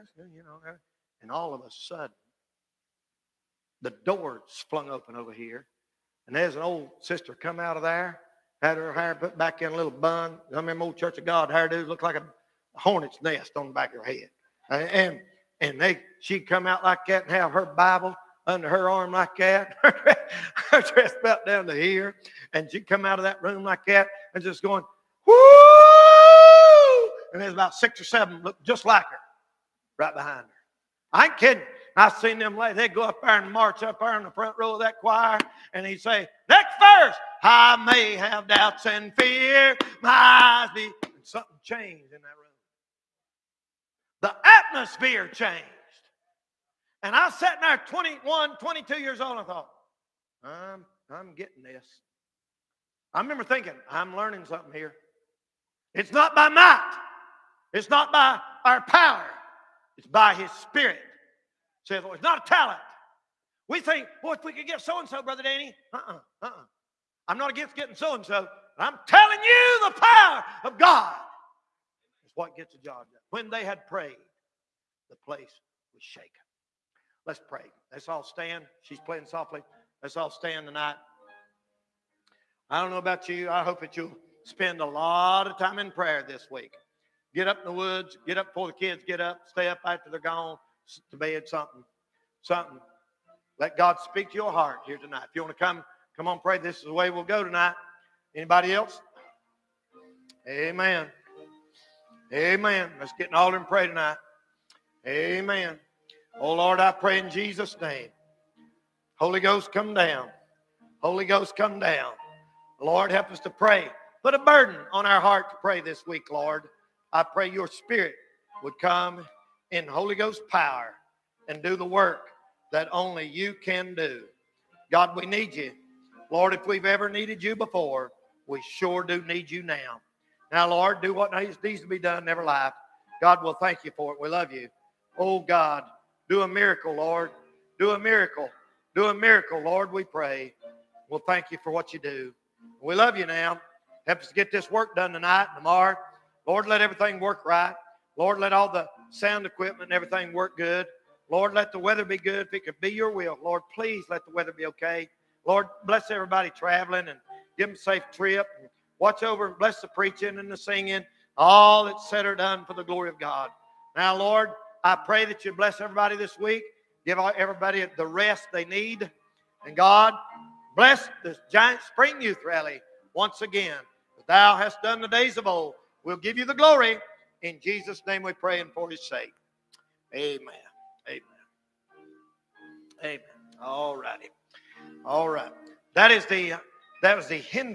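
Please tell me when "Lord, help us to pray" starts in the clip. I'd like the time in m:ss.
1:52.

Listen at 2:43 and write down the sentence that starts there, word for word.
Now, Lord, I pray that you bless everybody this week.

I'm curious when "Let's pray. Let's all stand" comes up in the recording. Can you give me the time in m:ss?
1:17.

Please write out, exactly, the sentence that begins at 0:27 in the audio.
And there's about six or seven look just like her right behind her.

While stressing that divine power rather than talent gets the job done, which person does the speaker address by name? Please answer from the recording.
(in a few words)
Brother Danny.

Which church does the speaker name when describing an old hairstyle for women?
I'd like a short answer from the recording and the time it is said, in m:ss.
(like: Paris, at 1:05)
Church of God, at 0:10.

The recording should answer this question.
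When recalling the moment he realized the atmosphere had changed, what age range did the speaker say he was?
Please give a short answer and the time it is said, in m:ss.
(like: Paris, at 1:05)
21, 22, at 0:47.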